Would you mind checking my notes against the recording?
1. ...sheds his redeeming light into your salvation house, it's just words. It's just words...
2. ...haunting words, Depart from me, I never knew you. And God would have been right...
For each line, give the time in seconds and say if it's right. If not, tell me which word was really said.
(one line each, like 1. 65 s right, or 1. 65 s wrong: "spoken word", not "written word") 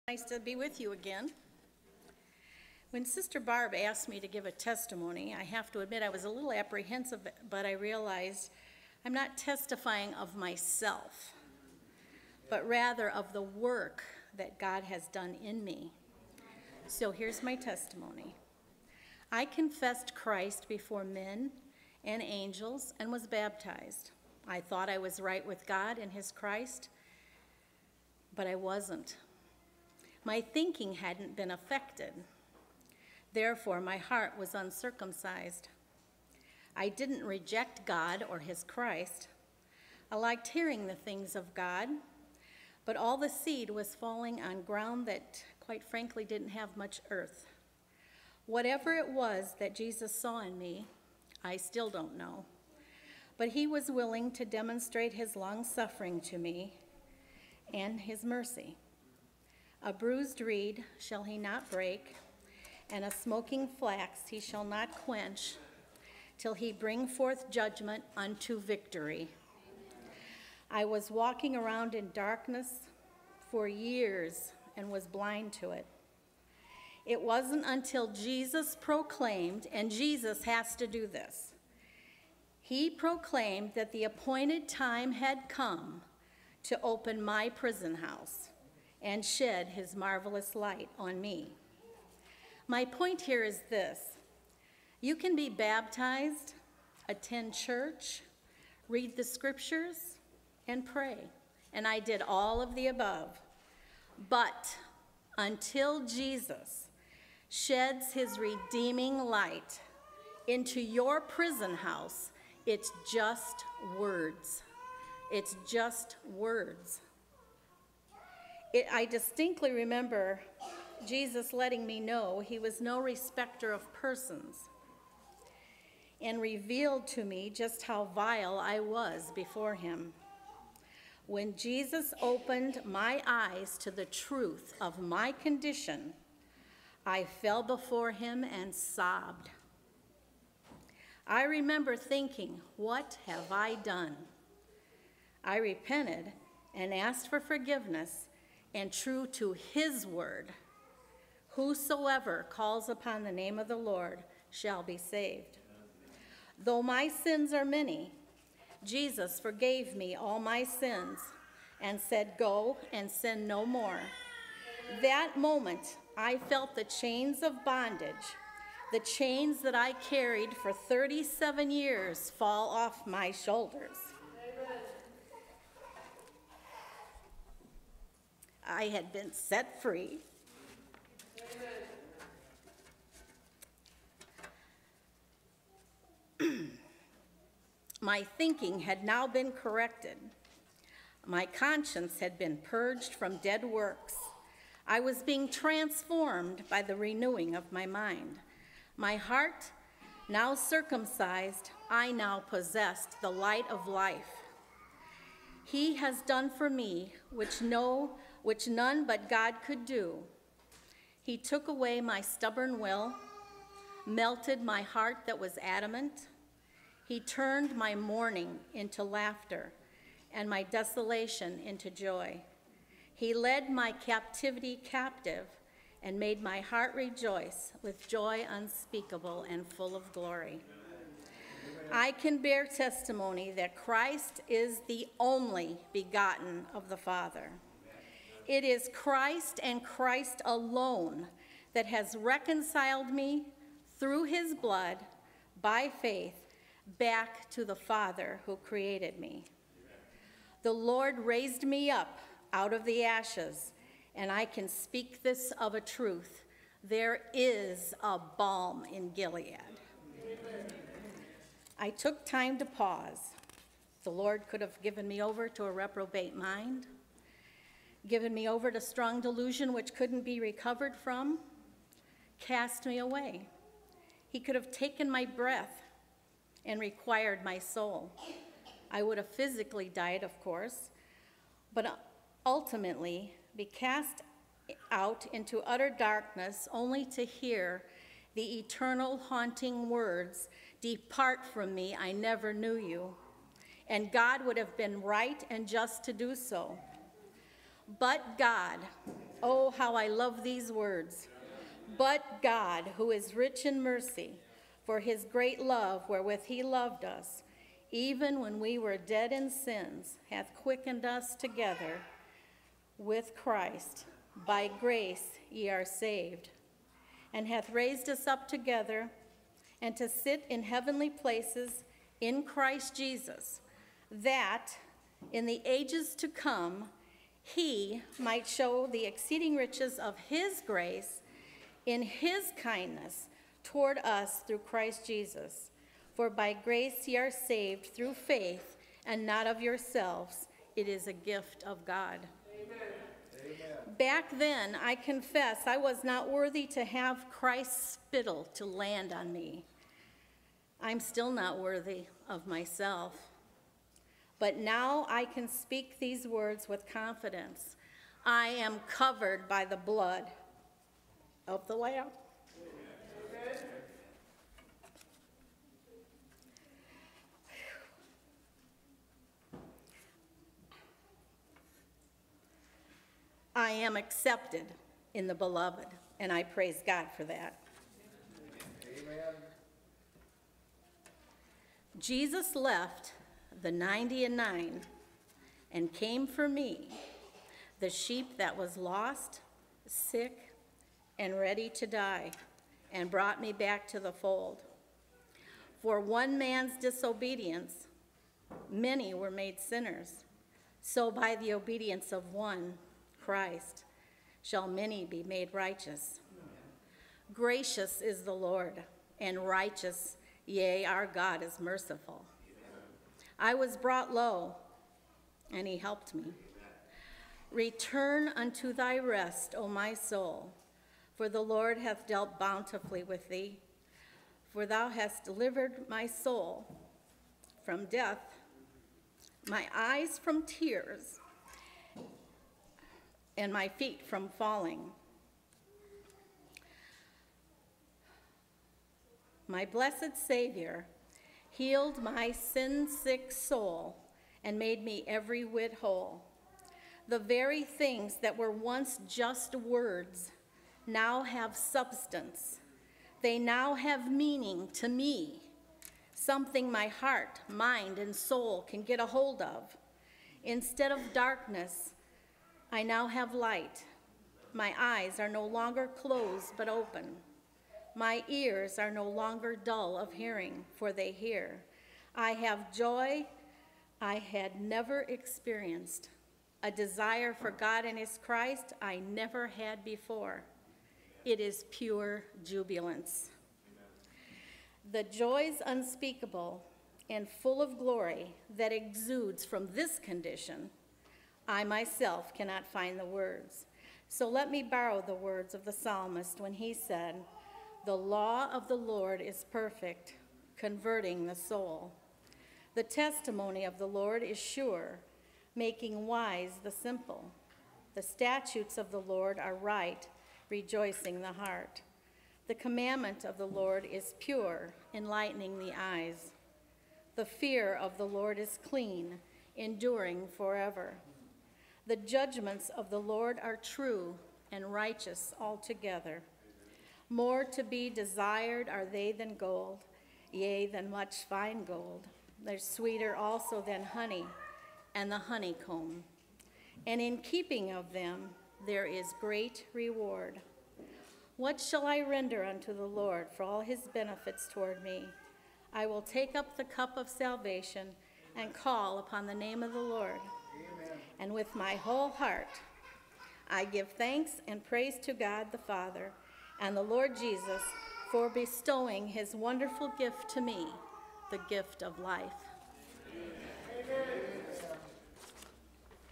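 1. 107 s wrong: "prison", not "salvation"
2. 289 s right.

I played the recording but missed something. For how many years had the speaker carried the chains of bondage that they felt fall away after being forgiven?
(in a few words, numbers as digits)
37.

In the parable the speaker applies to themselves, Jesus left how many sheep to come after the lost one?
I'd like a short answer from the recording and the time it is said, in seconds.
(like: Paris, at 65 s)
99, at 383 s.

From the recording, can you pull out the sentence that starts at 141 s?
I remember thinking, What have I done?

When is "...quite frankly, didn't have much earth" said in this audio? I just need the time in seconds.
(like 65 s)
45 s.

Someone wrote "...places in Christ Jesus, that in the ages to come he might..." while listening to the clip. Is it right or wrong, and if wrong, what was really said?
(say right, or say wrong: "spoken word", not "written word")
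right.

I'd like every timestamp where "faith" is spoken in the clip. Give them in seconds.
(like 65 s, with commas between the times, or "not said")
246 s, 338 s.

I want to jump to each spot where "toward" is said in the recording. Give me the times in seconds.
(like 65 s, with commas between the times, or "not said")
333 s, 544 s.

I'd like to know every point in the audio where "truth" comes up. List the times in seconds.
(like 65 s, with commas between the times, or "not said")
134 s, 255 s.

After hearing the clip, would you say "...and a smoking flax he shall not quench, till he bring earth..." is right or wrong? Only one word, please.
wrong.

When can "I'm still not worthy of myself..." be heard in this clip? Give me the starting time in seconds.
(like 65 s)
350 s.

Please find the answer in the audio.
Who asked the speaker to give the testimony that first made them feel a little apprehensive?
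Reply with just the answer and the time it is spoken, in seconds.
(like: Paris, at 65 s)
Sister Barb, at 3 s.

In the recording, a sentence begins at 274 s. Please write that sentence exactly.
He could have taken my breath and required my soul.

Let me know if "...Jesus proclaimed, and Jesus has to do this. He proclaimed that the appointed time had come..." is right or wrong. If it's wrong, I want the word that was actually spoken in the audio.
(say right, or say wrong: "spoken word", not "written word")
right.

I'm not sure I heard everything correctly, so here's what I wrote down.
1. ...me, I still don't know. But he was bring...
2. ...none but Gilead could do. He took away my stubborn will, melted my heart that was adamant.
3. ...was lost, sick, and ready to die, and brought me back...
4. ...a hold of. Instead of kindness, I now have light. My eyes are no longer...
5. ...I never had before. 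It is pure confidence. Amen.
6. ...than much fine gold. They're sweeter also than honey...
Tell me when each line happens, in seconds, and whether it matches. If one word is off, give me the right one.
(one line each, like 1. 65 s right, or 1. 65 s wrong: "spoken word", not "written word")
1. 50 s wrong: "willing", not "bring"
2. 208 s wrong: "God", not "Gilead"
3. 388 s right
4. 458 s wrong: "darkness", not "kindness"
5. 478 s wrong: "jubilance", not "confidence"
6. 530 s right.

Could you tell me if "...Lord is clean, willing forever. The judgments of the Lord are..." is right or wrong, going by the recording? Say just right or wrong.
wrong.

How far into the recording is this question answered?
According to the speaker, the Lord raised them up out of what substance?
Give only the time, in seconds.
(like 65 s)
253 s.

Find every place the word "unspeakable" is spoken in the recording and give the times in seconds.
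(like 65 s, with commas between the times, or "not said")
228 s, 485 s.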